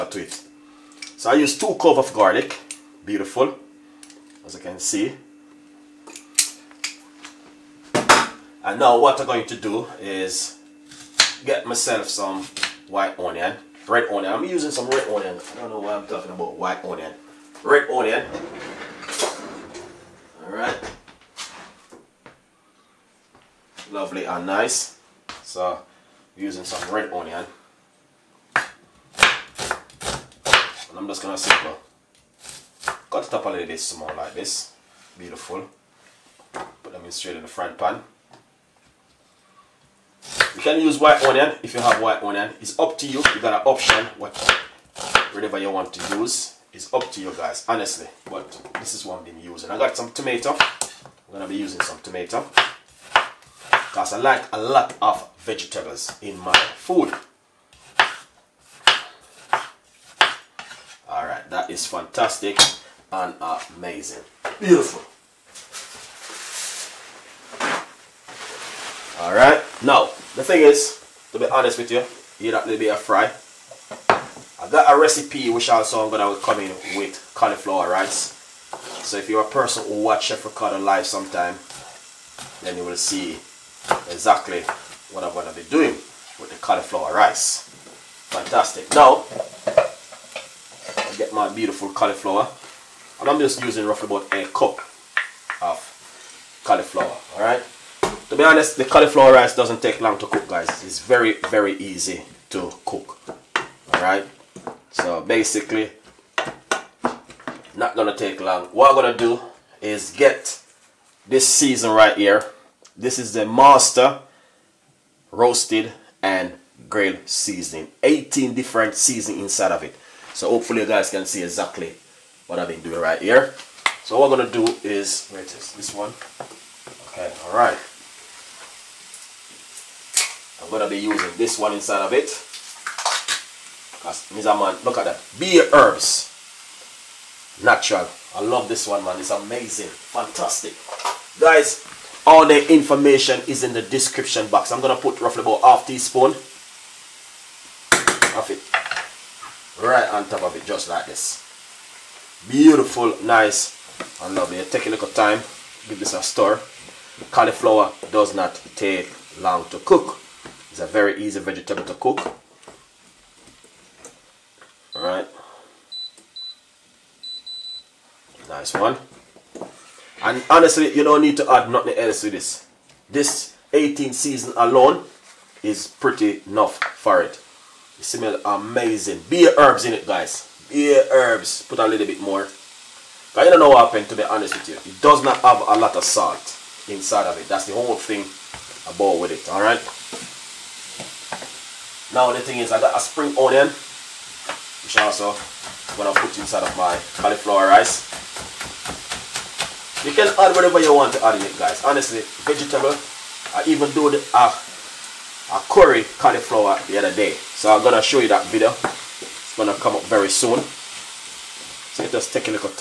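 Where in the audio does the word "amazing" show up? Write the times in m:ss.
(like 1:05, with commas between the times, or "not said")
1:03, 2:19, 2:58.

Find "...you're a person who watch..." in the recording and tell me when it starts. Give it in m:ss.
1:19.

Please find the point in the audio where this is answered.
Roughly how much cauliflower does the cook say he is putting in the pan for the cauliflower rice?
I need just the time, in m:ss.
1:34.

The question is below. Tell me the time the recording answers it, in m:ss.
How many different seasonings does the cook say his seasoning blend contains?
1:58.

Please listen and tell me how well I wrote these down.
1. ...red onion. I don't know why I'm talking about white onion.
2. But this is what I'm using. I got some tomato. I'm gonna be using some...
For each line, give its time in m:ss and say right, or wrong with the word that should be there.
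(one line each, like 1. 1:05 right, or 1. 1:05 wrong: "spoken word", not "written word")
1. 0:14 right
2. 0:48 right.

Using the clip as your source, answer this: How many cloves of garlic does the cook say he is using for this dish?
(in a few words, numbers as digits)
2.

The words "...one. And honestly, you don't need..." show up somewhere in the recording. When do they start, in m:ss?
2:48.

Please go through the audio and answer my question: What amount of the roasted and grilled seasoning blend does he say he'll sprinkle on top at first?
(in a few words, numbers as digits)
half teaspoon.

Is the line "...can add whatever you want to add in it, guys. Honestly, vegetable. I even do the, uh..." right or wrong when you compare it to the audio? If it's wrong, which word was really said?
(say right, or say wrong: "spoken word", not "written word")
right.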